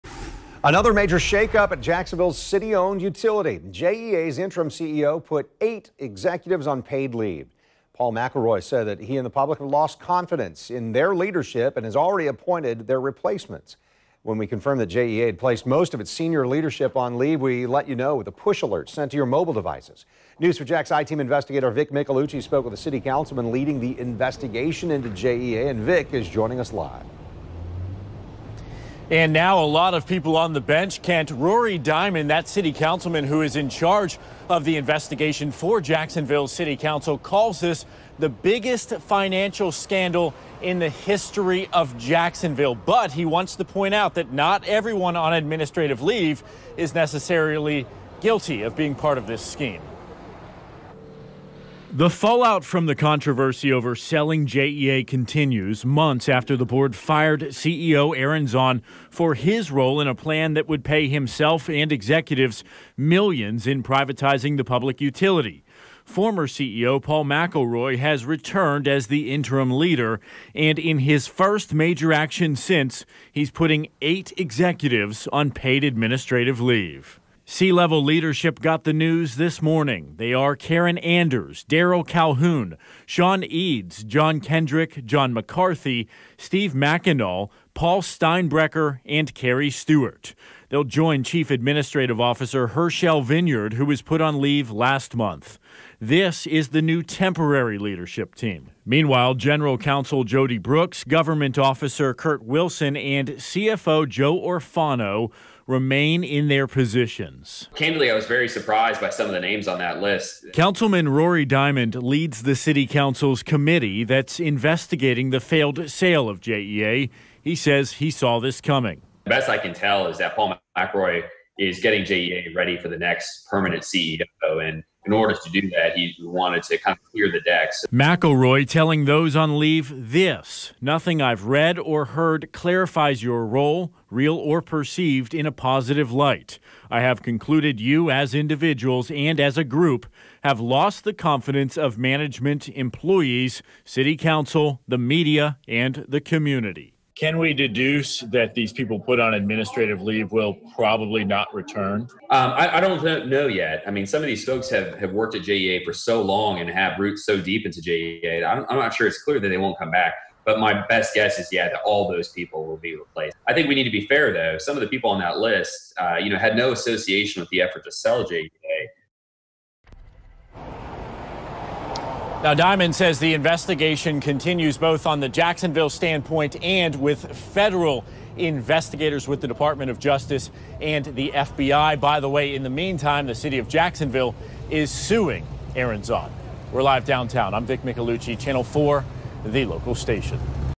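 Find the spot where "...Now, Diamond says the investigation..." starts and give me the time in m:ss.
2:52.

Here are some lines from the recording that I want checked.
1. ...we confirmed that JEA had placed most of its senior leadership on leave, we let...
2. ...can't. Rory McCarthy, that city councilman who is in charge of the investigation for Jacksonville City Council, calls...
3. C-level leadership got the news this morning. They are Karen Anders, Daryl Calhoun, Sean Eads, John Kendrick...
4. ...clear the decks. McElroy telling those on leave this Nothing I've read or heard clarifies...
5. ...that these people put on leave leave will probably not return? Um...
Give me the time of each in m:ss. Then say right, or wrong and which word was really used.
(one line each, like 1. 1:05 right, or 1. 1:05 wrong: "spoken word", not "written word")
1. 0:14 right
2. 0:31 wrong: "Diamond", not "McCarthy"
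3. 1:17 right
4. 2:07 right
5. 2:28 wrong: "administrative", not "leave".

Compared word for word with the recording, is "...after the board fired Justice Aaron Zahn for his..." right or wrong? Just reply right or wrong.
wrong.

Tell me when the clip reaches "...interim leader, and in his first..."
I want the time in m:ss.
1:09.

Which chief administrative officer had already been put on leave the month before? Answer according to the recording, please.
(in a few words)
Herschel Vinyard.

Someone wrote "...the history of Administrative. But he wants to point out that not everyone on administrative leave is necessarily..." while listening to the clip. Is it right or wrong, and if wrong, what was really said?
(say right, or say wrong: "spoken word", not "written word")
wrong: "Jacksonville", not "Administrative".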